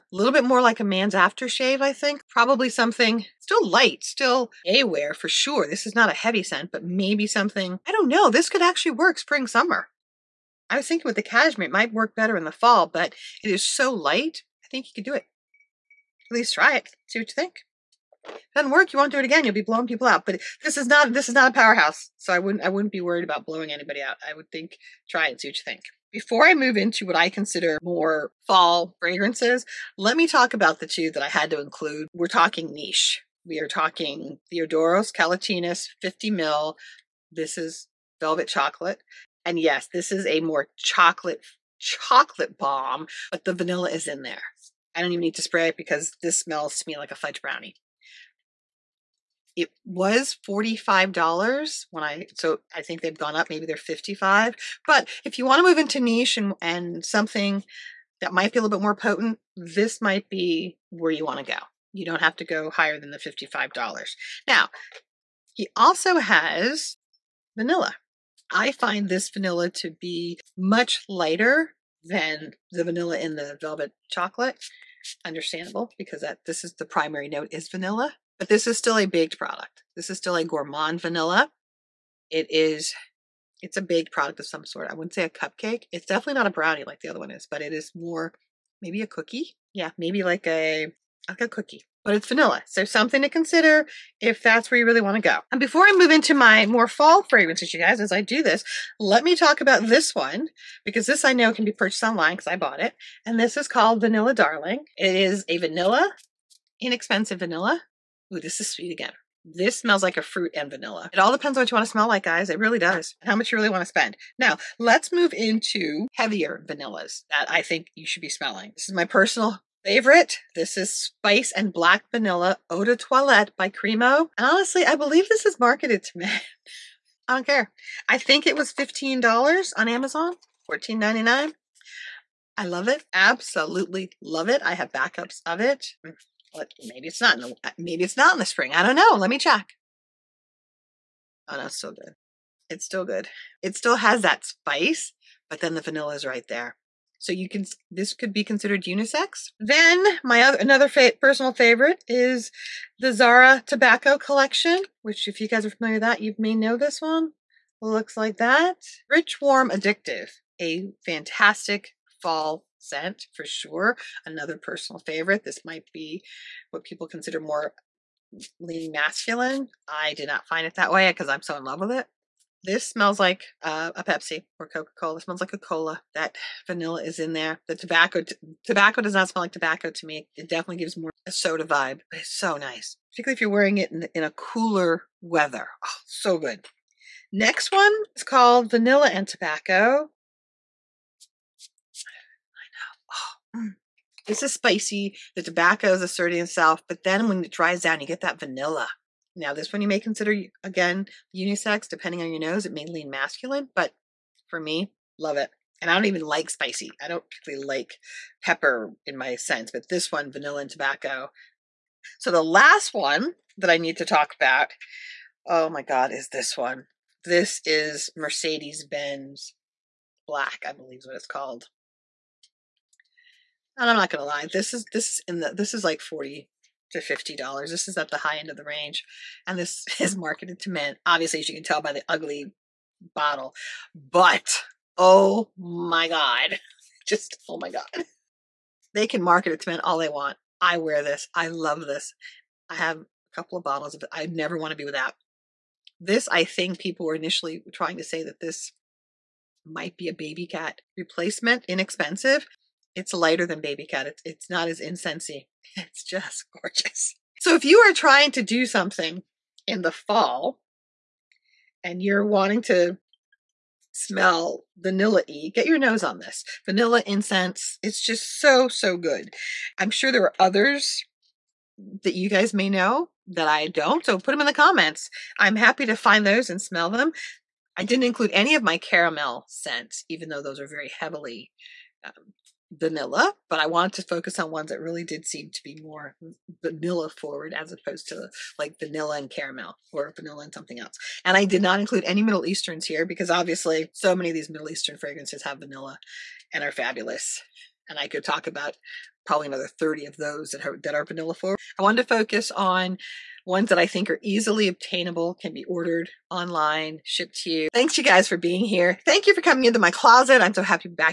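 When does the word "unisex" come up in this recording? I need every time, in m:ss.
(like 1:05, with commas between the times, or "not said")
2:28, 3:21.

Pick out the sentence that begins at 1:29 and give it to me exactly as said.
Yeah, maybe like a like a cookie.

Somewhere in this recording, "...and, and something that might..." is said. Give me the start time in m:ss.
0:56.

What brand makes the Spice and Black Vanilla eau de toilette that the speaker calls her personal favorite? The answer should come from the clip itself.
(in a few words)
Cremo.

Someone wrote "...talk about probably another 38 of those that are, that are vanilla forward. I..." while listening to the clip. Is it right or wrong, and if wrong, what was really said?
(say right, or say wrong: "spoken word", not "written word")
wrong: "30", not "38".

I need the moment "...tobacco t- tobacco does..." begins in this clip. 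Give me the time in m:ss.
2:57.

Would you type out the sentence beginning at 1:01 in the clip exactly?
You don't have to go higher than the $55.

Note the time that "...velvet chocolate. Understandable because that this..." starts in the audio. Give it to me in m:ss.
1:13.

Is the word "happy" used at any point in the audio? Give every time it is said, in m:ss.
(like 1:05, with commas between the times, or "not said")
4:35, 5:10.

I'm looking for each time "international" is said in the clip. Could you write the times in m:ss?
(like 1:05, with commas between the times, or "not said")
not said.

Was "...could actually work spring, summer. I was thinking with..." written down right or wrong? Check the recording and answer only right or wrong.
right.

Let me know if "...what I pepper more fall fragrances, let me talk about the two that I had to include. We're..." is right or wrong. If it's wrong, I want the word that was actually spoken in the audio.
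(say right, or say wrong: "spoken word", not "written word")
wrong: "consider", not "pepper".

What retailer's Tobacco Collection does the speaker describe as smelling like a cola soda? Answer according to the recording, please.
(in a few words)
Zara.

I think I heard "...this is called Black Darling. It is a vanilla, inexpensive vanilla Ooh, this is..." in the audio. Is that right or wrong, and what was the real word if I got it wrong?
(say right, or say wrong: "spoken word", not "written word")
wrong: "Vanilla", not "Black".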